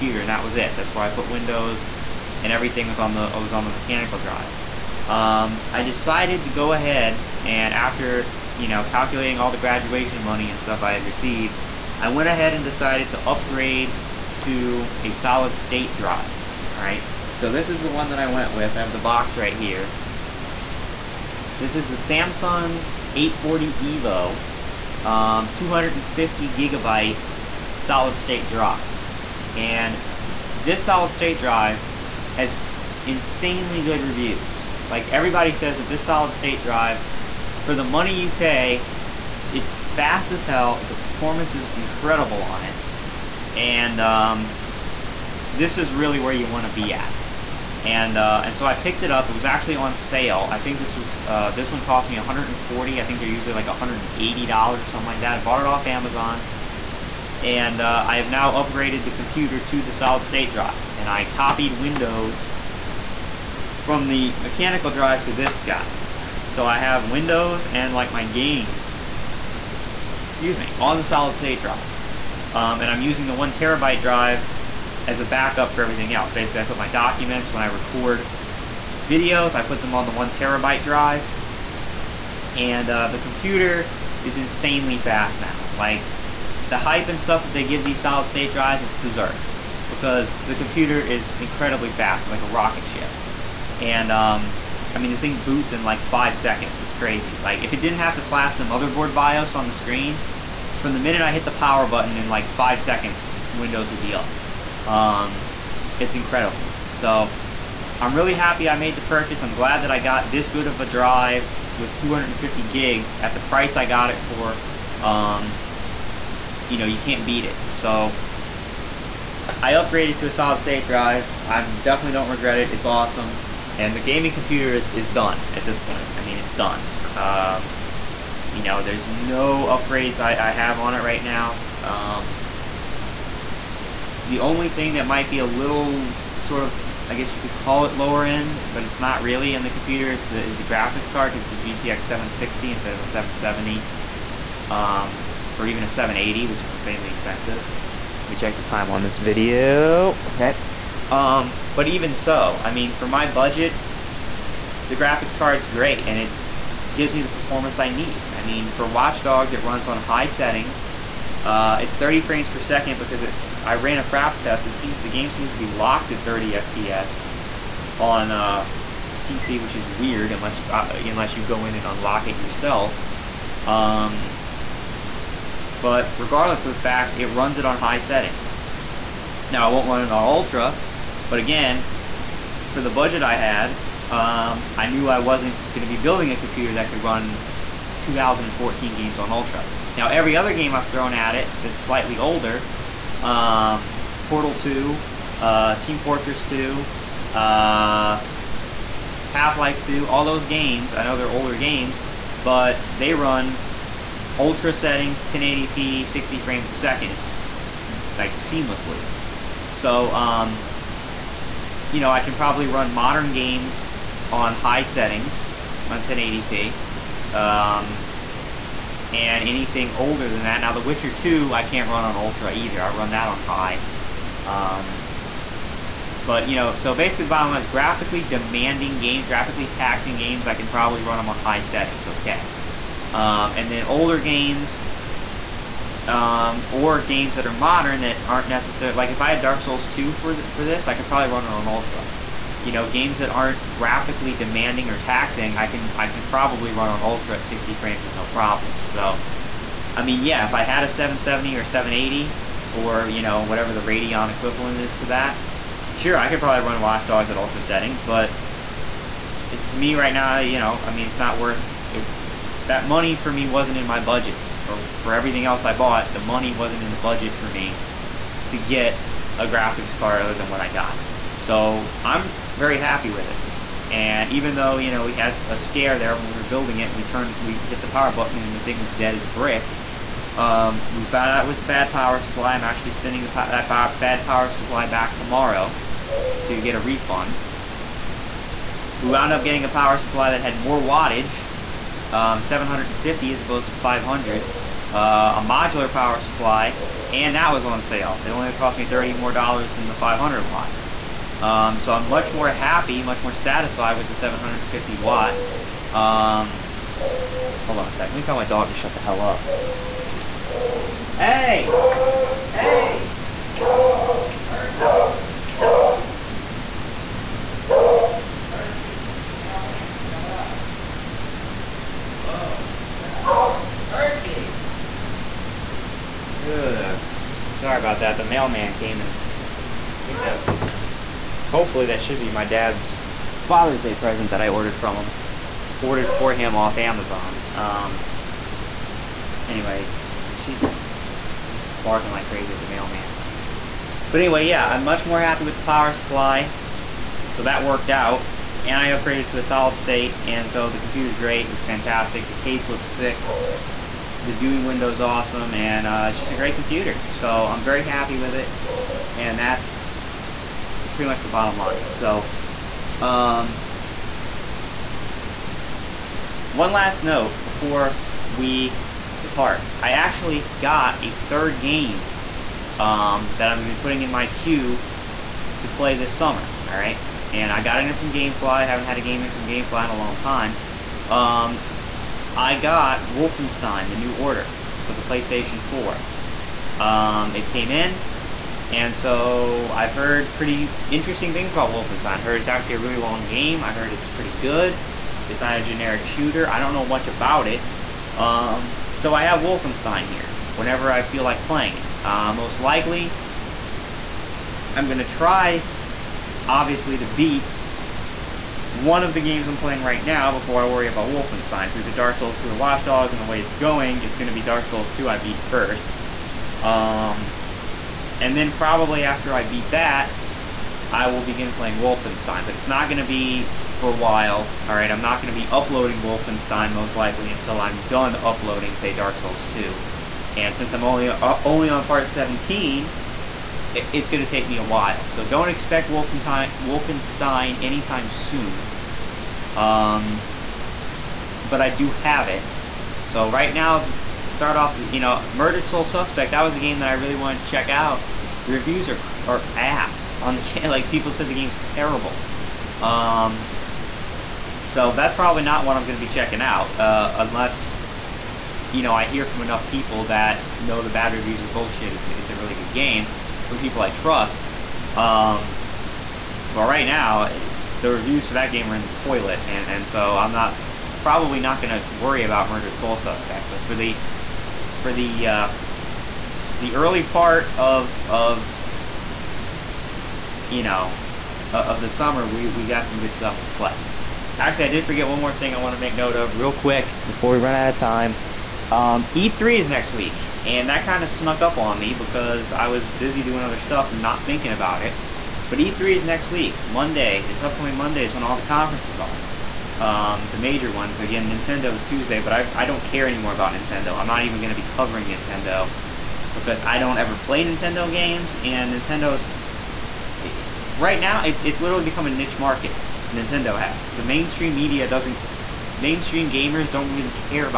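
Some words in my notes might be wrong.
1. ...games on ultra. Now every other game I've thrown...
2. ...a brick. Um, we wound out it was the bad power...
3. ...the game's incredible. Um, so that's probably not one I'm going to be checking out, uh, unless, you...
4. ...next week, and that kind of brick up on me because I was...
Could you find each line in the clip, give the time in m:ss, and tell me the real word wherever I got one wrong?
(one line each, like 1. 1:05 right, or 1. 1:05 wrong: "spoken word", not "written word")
1. 3:08 right
2. 4:39 wrong: "found", not "wound"
3. 7:31 wrong: "terrible", not "incredible"
4. 8:09 wrong: "snuck", not "brick".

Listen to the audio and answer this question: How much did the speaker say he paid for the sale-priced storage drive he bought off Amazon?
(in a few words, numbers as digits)
$140.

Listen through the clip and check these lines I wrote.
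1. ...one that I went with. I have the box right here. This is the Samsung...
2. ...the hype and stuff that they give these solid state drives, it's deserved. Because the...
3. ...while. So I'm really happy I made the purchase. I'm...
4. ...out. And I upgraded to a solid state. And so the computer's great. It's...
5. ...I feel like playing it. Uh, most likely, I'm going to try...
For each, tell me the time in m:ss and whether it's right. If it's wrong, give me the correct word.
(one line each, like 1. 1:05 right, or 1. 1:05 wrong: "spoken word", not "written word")
1. 0:17 right
2. 1:26 right
3. 1:46 wrong: "incredible", not "while"
4. 5:47 right
5. 6:40 right.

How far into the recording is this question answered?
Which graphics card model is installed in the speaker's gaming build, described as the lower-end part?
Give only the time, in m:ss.
2:21.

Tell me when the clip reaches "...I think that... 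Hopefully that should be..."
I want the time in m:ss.
5:29.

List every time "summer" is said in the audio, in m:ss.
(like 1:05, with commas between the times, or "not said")
6:16, 8:01.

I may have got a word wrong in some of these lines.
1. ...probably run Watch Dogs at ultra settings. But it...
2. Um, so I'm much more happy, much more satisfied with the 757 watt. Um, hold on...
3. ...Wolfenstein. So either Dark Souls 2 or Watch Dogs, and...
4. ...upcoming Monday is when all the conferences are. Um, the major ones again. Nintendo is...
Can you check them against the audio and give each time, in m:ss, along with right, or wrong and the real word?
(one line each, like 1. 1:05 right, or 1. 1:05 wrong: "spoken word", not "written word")
1. 4:16 right
2. 5:01 wrong: "750", not "757"
3. 6:51 right
4. 8:17 right.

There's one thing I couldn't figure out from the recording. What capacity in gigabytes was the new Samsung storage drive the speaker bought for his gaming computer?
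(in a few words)
250.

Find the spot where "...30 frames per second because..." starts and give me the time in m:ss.
2:41.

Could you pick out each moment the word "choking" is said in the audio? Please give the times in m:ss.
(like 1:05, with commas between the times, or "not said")
not said.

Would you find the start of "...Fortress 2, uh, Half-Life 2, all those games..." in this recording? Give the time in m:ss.
3:15.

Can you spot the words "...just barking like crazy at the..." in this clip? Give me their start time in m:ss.
5:41.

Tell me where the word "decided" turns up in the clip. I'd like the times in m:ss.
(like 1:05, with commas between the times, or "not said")
0:05, 0:12.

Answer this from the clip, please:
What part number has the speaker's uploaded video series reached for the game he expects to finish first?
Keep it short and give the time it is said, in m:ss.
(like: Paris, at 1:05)
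17, at 7:11.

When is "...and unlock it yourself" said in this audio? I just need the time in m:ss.
2:51.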